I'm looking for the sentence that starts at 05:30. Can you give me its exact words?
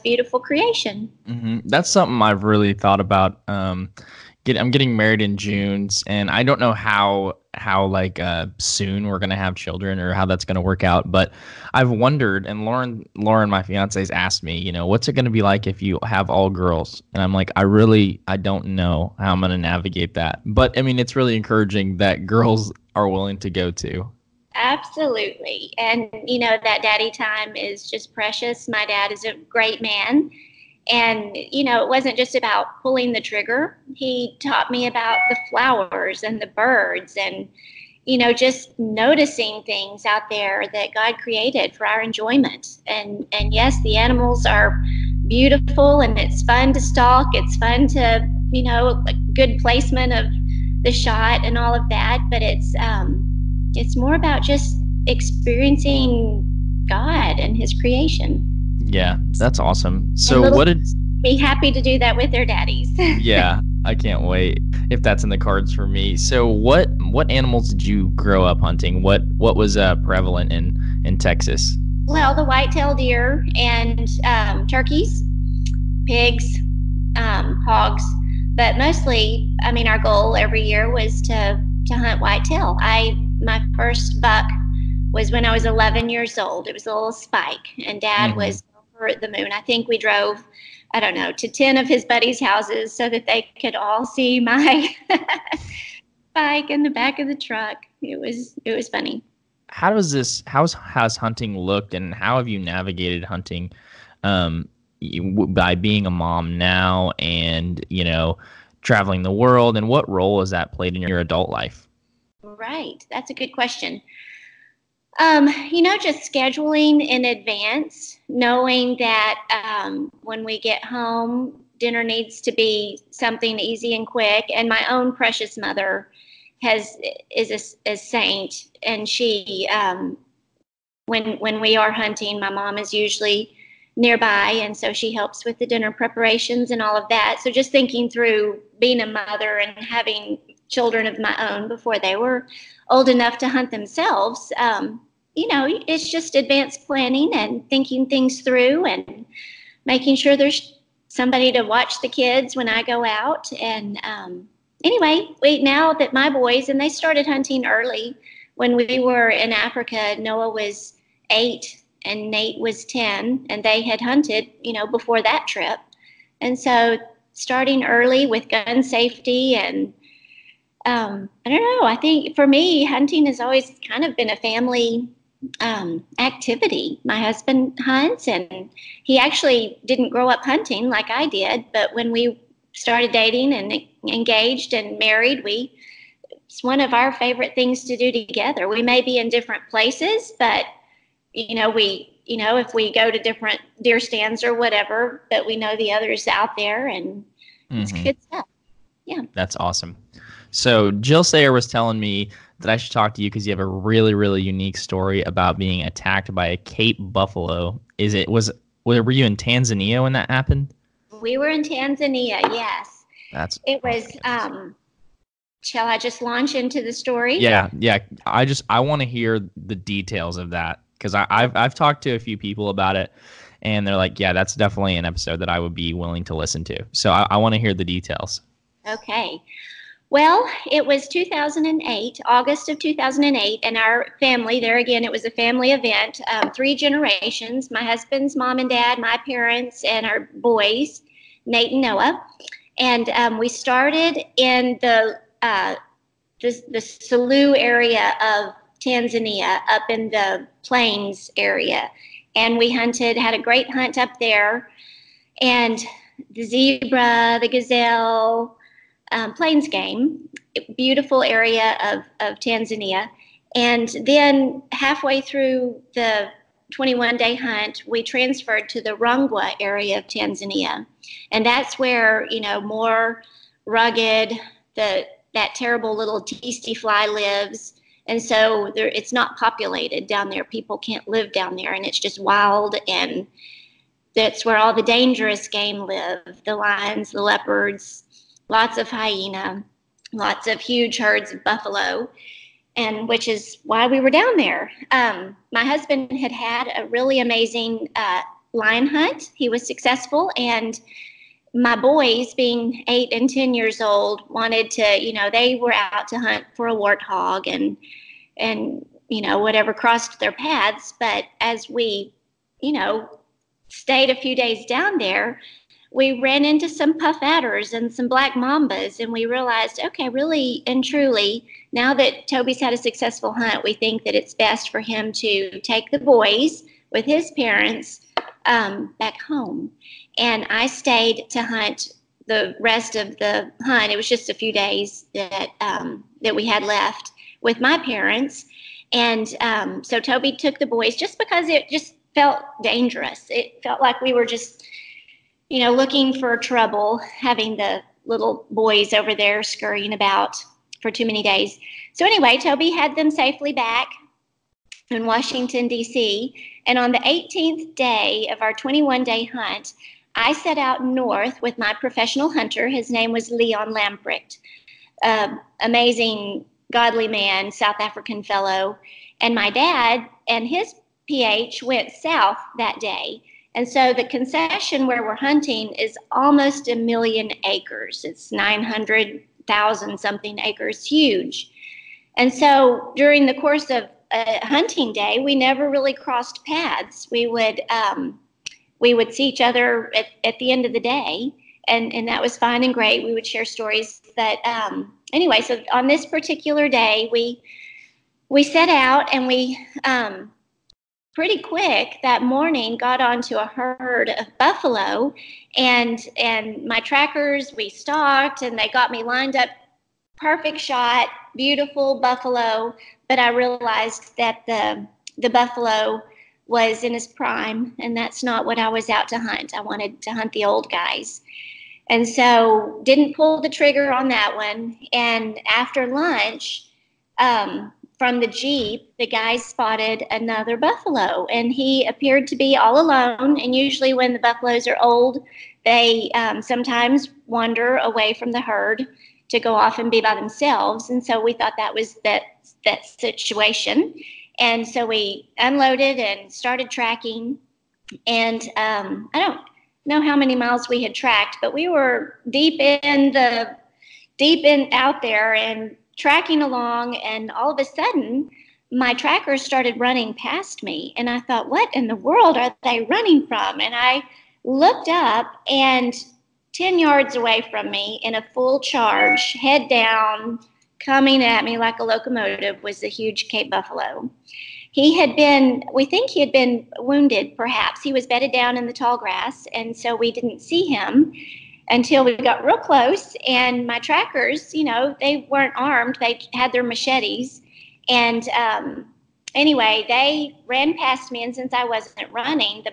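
And I stayed to hunt the rest of the hunt.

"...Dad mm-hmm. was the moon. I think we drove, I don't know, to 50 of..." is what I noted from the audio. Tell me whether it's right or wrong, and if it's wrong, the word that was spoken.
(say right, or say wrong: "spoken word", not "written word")
wrong: "10", not "50".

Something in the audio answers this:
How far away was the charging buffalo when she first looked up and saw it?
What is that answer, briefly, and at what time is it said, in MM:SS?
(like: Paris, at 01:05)
10 yards, at 07:46.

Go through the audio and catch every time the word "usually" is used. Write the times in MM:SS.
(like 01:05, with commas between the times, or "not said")
02:12, 07:13.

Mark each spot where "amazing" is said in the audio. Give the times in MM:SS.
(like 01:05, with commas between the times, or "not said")
04:57, 06:05.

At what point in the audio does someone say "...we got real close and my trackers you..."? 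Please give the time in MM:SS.
08:02.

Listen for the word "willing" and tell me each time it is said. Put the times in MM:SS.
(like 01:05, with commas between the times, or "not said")
00:23, 03:45.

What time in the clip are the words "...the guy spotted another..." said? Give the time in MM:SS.
07:08.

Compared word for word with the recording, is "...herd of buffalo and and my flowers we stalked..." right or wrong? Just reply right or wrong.
wrong.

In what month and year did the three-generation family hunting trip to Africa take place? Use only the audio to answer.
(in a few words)
August 2008.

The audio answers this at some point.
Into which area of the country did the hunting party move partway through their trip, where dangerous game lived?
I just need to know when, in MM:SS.
04:28.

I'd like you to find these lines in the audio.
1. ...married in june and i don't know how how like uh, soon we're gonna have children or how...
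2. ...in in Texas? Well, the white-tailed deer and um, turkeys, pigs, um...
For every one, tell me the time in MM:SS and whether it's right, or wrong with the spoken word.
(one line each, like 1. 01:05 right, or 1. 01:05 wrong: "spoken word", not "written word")
1. 00:04 right
2. 01:10 right.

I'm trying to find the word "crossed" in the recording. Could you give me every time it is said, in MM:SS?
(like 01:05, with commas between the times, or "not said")
05:09, 06:25.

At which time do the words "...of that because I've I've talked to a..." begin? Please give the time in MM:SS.
03:40.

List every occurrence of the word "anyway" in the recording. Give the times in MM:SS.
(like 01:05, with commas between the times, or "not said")
02:34, 05:52, 06:35, 08:09.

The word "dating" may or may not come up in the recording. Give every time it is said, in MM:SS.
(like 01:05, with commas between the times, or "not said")
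03:03.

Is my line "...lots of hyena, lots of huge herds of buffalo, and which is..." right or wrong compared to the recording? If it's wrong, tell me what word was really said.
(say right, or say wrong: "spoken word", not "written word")
right.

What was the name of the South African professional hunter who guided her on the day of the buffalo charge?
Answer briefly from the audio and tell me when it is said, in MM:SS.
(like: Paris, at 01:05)
Leon Lamprecht, at 06:03.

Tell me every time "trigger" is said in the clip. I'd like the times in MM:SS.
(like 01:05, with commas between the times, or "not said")
00:33, 07:03.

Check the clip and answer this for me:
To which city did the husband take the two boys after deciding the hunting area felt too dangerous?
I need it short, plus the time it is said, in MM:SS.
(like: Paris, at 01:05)
Washington, D.C., at 05:55.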